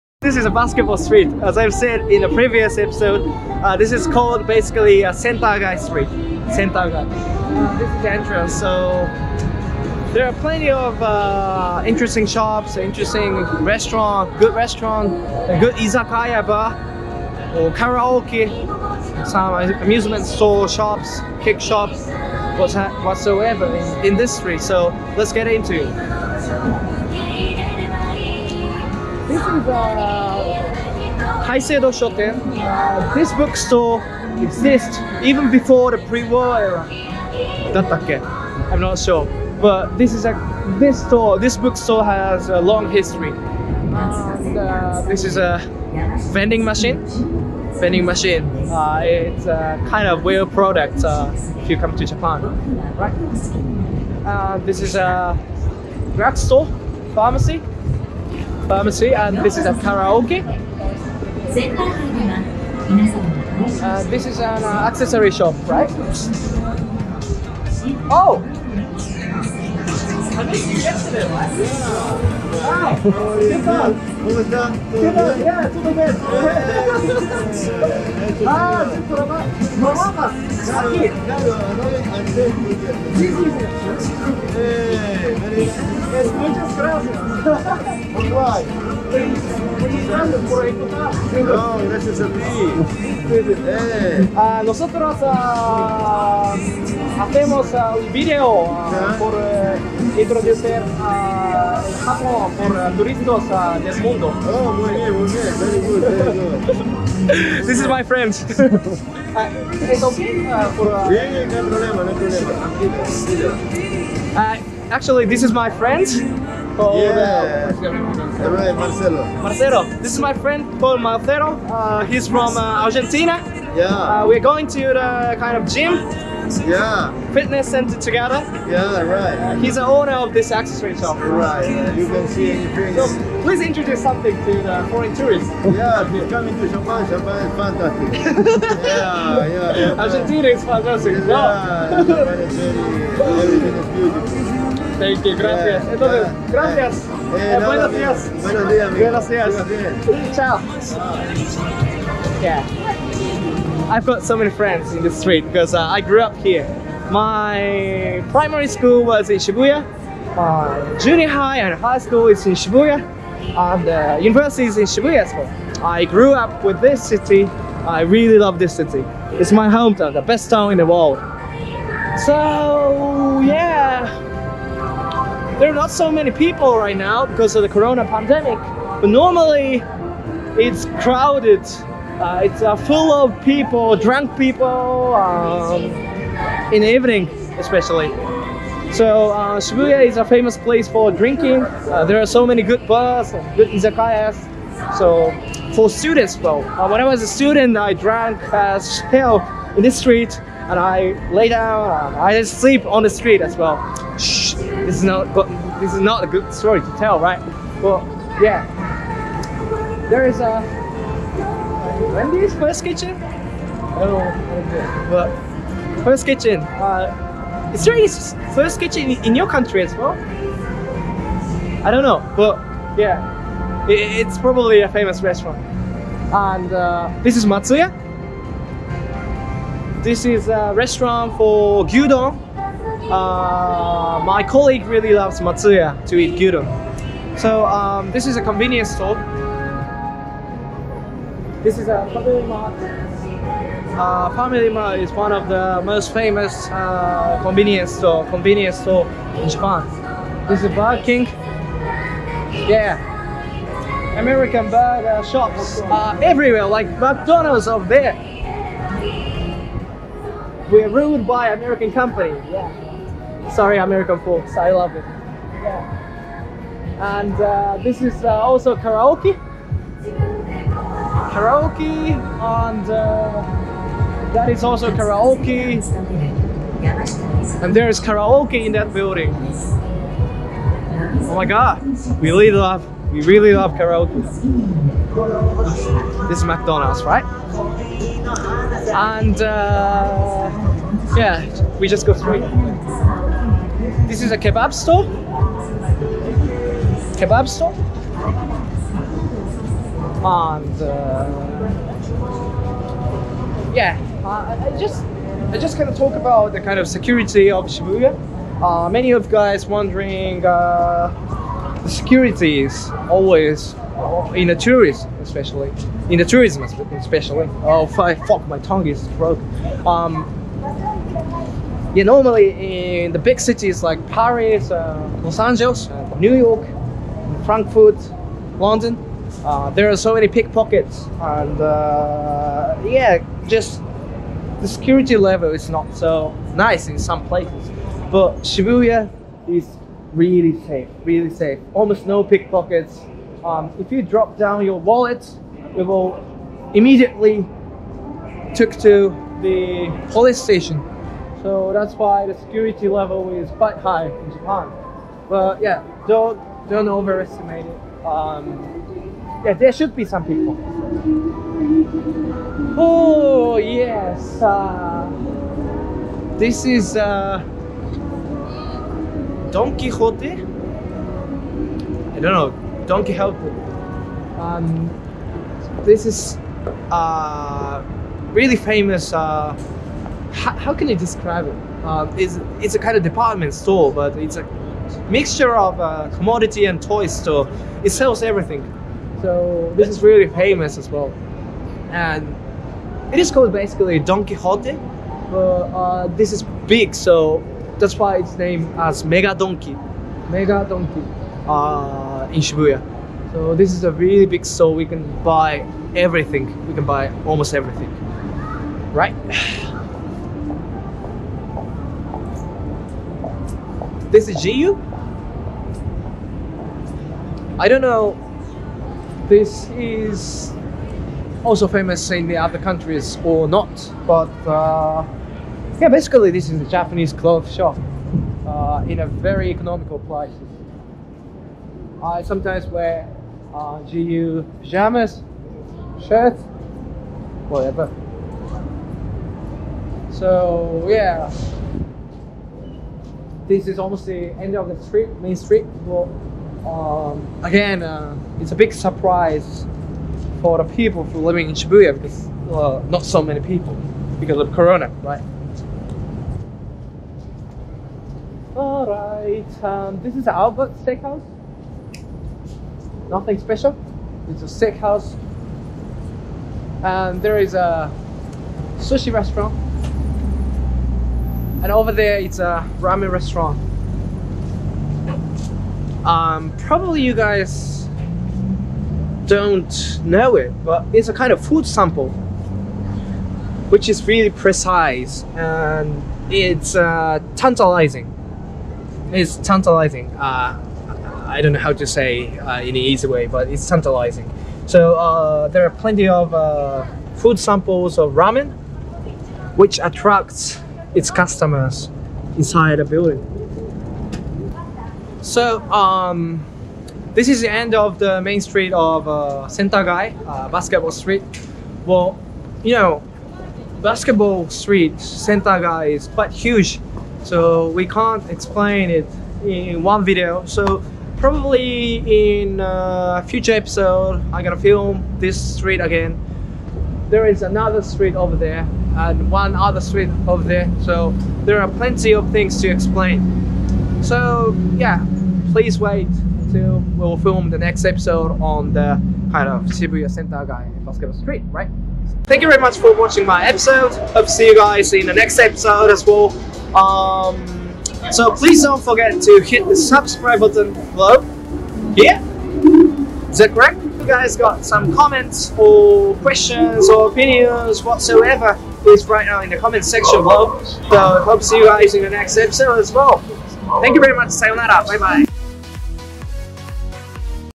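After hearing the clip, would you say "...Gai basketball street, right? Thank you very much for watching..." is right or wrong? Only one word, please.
right.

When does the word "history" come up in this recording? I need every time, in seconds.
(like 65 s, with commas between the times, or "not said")
42 s.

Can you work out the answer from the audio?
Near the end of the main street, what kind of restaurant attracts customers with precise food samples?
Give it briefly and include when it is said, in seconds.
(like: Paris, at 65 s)
Ramen restaurant, at 472 s.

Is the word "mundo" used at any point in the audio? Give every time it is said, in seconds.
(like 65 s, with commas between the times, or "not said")
104 s.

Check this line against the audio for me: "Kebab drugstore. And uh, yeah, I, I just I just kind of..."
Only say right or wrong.
wrong.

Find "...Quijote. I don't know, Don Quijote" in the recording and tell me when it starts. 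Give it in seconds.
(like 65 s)
369 s.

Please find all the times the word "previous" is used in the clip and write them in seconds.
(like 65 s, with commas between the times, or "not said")
2 s.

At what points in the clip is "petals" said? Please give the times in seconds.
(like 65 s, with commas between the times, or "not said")
not said.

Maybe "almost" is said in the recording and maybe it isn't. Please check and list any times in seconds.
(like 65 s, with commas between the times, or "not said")
341 s, 407 s, 443 s.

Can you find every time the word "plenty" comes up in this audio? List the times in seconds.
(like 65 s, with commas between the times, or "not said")
10 s, 495 s, 531 s.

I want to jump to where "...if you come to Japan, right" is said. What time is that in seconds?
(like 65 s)
51 s.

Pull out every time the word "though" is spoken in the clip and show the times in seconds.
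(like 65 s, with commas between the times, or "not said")
196 s.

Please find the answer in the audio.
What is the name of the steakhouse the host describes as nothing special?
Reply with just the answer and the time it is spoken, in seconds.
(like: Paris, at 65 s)
Albert Steakhouse, at 460 s.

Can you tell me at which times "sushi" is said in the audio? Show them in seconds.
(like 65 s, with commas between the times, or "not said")
468 s.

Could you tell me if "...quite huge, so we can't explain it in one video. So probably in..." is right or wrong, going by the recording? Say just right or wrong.
right.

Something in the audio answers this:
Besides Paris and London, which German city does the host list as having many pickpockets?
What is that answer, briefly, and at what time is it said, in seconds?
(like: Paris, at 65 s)
Frankfurt, at 327 s.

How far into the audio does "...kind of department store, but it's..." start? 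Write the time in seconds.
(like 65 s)
382 s.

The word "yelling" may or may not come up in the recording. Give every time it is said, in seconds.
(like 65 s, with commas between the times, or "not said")
not said.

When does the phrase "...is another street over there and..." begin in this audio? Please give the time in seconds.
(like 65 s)
527 s.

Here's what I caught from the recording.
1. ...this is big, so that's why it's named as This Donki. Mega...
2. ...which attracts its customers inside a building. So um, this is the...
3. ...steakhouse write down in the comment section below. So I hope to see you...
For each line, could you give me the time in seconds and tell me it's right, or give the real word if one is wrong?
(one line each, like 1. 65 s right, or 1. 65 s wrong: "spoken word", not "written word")
1. 396 s wrong: "Mega", not "This"
2. 499 s right
3. 558 s wrong: "please", not "steakhouse".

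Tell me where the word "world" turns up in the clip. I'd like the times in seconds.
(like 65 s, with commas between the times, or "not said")
170 s.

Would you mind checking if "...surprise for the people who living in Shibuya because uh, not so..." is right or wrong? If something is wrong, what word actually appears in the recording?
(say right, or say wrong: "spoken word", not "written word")
right.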